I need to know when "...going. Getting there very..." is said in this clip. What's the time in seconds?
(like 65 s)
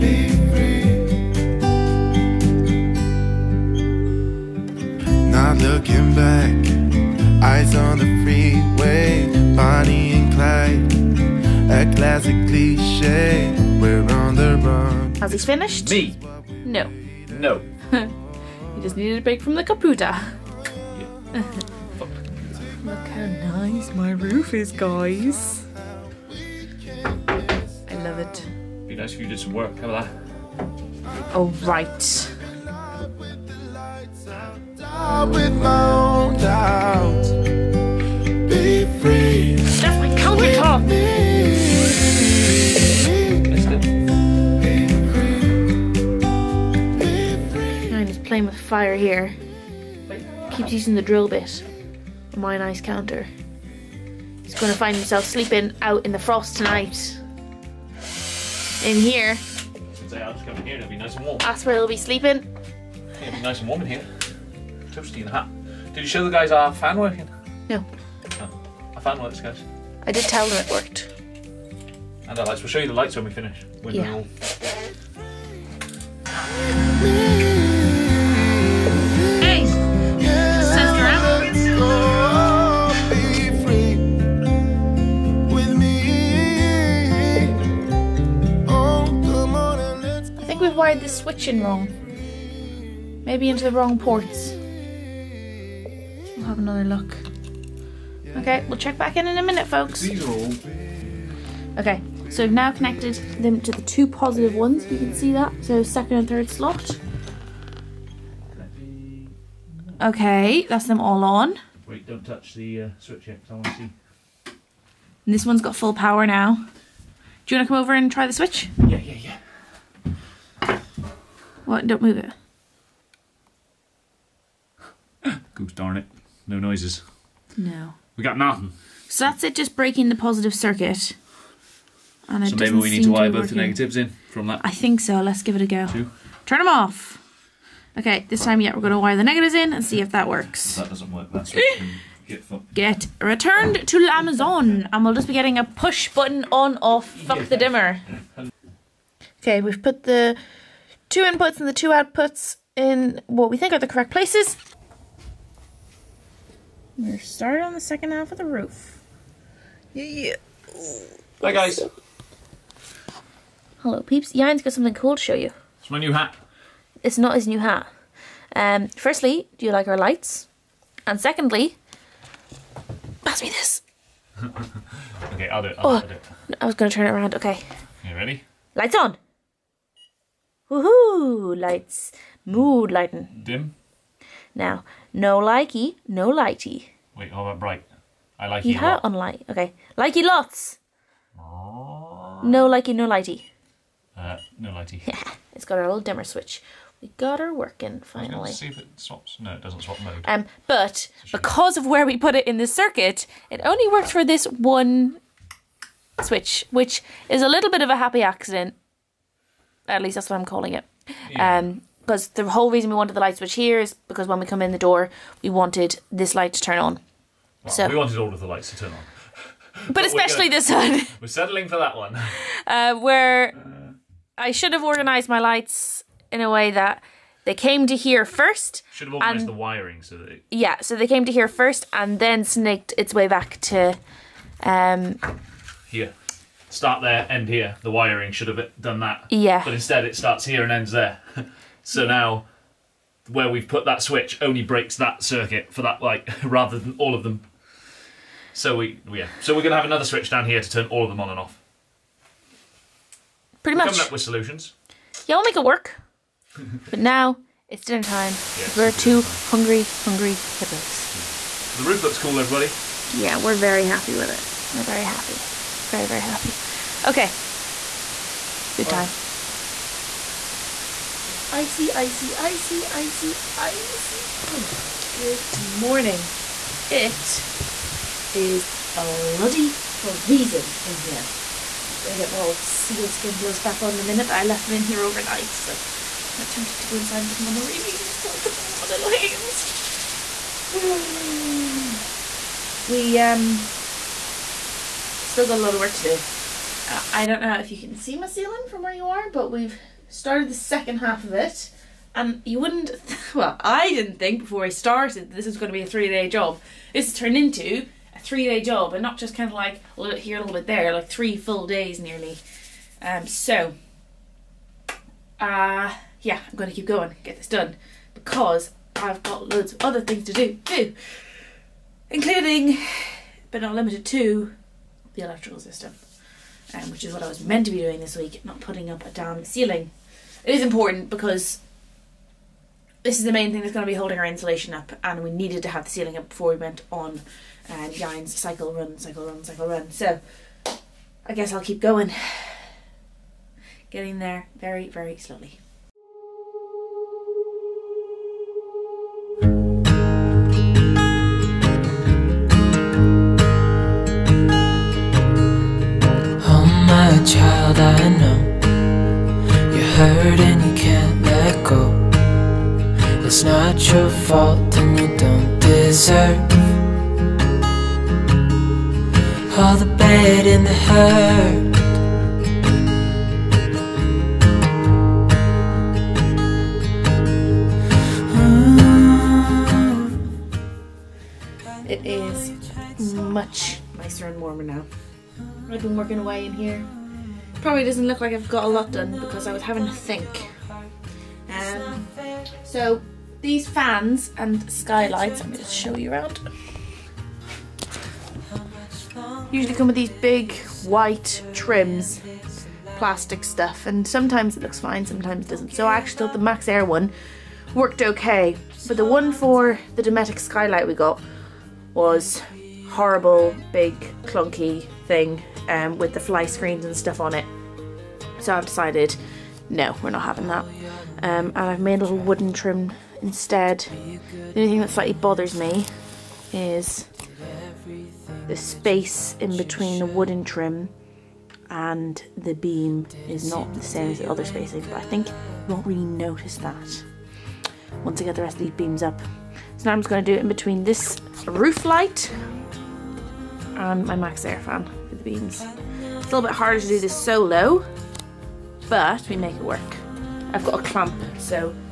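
341 s.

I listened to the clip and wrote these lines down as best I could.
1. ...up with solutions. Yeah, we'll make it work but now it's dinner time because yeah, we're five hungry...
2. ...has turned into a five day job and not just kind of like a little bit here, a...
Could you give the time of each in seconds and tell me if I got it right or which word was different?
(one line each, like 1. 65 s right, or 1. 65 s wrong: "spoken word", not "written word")
1. 254 s wrong: "two", not "five"
2. 307 s wrong: "three", not "five".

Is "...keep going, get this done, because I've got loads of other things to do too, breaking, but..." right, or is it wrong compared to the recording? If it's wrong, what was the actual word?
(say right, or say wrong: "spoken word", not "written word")
wrong: "including", not "breaking".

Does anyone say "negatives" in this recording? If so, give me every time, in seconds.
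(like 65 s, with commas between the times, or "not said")
133 s, 139 s.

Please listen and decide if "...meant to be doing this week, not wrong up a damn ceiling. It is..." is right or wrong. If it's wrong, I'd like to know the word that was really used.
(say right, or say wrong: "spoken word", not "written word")
wrong: "putting", not "wrong".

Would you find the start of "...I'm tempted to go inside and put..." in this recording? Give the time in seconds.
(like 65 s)
286 s.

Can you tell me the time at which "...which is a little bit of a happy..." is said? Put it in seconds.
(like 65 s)
206 s.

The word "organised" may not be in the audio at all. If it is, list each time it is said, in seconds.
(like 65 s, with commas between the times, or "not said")
224 s, 229 s.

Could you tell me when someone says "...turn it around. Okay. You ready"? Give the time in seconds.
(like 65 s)
176 s.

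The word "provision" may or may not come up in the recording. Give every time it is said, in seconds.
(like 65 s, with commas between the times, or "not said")
not said.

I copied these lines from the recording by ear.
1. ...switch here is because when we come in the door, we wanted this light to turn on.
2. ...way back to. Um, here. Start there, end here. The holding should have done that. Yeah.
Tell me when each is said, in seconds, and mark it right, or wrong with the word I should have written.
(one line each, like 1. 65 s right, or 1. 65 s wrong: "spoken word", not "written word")
1. 213 s right
2. 233 s wrong: "wiring", not "holding".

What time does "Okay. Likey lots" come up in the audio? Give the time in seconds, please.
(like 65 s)
189 s.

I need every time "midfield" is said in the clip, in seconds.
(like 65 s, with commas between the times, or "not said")
not said.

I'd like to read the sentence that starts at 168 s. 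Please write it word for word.
Um, firstly, do you like our lights?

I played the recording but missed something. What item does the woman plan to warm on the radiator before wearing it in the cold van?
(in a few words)
sealskin gloves.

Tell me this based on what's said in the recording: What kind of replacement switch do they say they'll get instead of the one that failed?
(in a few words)
push button on off.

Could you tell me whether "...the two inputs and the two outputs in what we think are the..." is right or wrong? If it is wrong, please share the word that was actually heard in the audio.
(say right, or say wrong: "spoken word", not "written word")
right.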